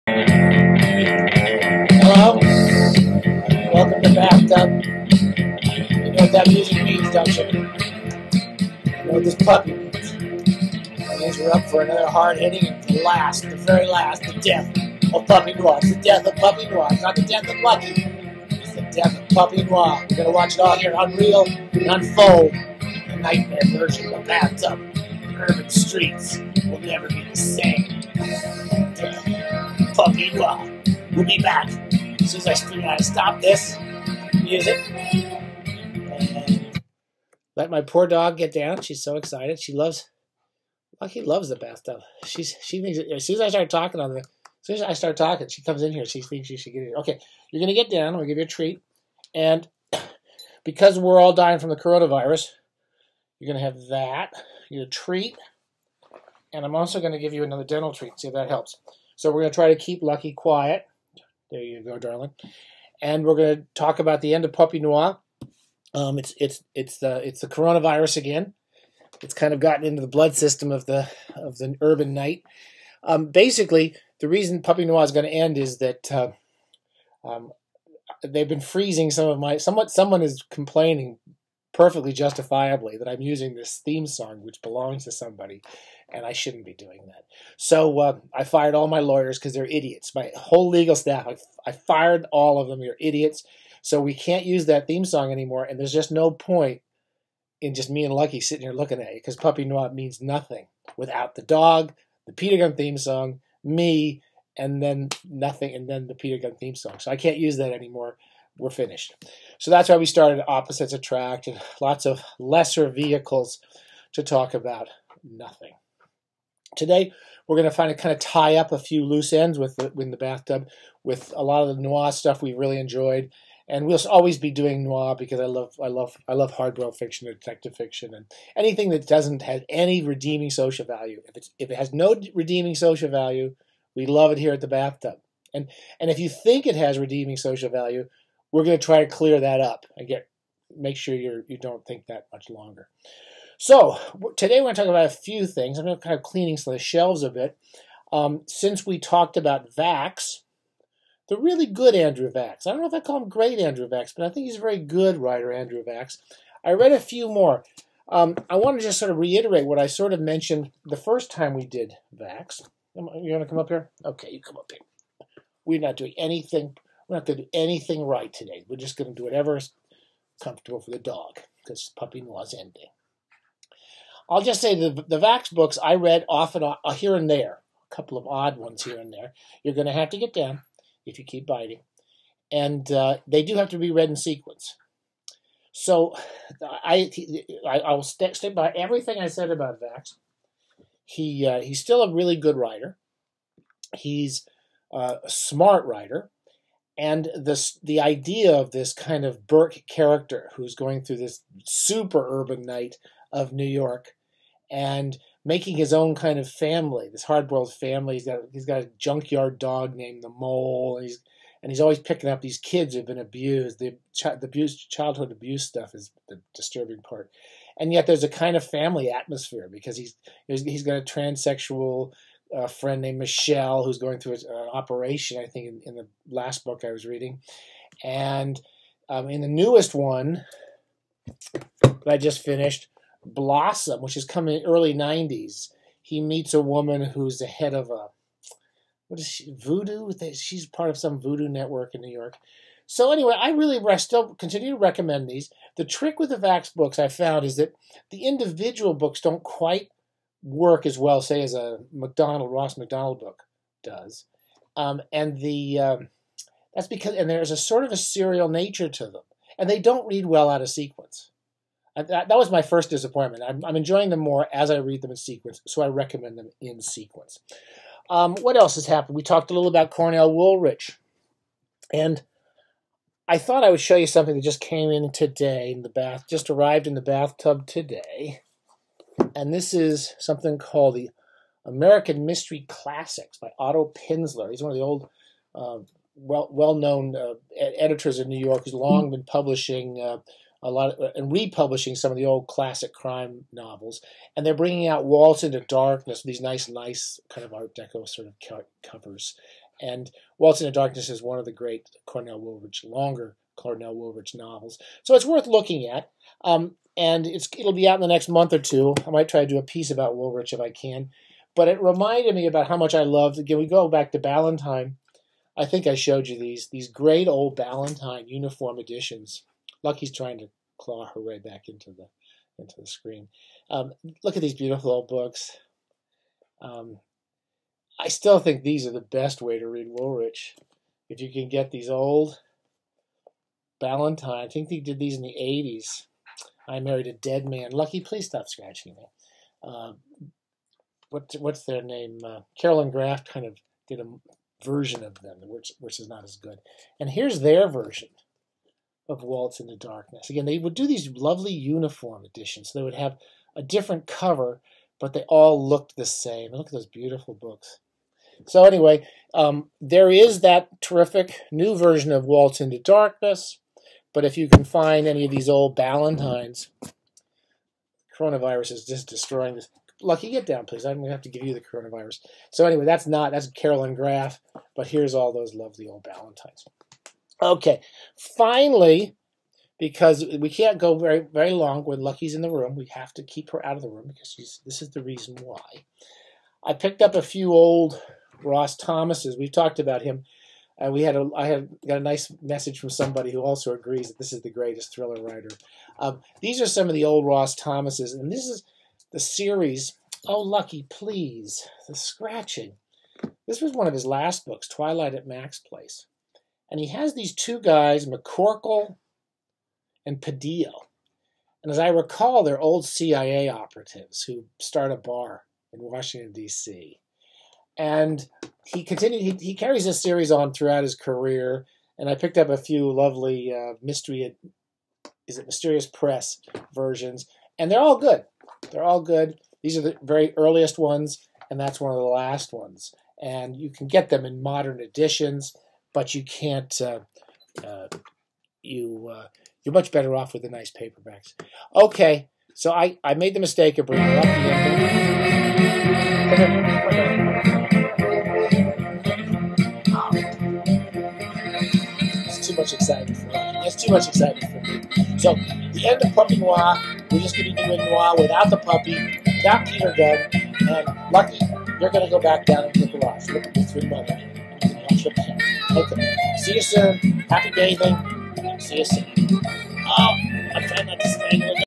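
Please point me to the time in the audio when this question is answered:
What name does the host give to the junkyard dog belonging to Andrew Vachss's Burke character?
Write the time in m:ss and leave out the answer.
3:30.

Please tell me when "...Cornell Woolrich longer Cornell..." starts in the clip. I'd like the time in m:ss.
5:02.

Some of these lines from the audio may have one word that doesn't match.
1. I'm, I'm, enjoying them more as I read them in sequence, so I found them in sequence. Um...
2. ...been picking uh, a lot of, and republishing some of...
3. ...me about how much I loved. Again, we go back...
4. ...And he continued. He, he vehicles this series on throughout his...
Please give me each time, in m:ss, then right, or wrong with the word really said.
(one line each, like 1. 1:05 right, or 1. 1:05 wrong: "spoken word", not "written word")
1. 4:23 wrong: "recommend", not "found"
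2. 4:49 wrong: "publishing", not "picking"
3. 5:12 right
4. 6:57 wrong: "carries", not "vehicles".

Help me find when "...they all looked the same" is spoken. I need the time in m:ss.
5:55.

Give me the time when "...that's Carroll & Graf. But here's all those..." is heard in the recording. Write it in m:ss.
6:13.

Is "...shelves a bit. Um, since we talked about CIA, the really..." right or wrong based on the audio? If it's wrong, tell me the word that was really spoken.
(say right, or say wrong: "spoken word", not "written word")
wrong: "Vachss", not "CIA".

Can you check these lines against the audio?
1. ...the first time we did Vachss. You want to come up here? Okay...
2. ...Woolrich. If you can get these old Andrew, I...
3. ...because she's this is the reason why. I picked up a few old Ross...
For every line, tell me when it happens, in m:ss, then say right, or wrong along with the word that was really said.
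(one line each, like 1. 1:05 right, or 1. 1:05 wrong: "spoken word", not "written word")
1. 2:40 right
2. 5:29 wrong: "Ballantine", not "Andrew"
3. 6:24 right.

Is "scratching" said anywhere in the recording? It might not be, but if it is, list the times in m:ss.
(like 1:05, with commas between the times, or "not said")
5:38, 6:41.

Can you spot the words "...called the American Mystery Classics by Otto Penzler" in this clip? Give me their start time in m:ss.
4:40.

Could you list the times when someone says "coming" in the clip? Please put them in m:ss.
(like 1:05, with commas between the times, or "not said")
3:54.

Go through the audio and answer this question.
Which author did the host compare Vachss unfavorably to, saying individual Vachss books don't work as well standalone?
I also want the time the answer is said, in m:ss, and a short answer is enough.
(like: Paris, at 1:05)
Ross Macdonald, at 4:12.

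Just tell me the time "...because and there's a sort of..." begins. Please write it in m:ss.
4:16.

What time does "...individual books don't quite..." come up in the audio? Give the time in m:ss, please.
4:08.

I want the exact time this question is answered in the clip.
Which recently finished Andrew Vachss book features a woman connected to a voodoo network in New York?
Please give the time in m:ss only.
3:53.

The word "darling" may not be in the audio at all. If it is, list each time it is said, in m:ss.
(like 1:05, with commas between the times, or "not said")
1:01.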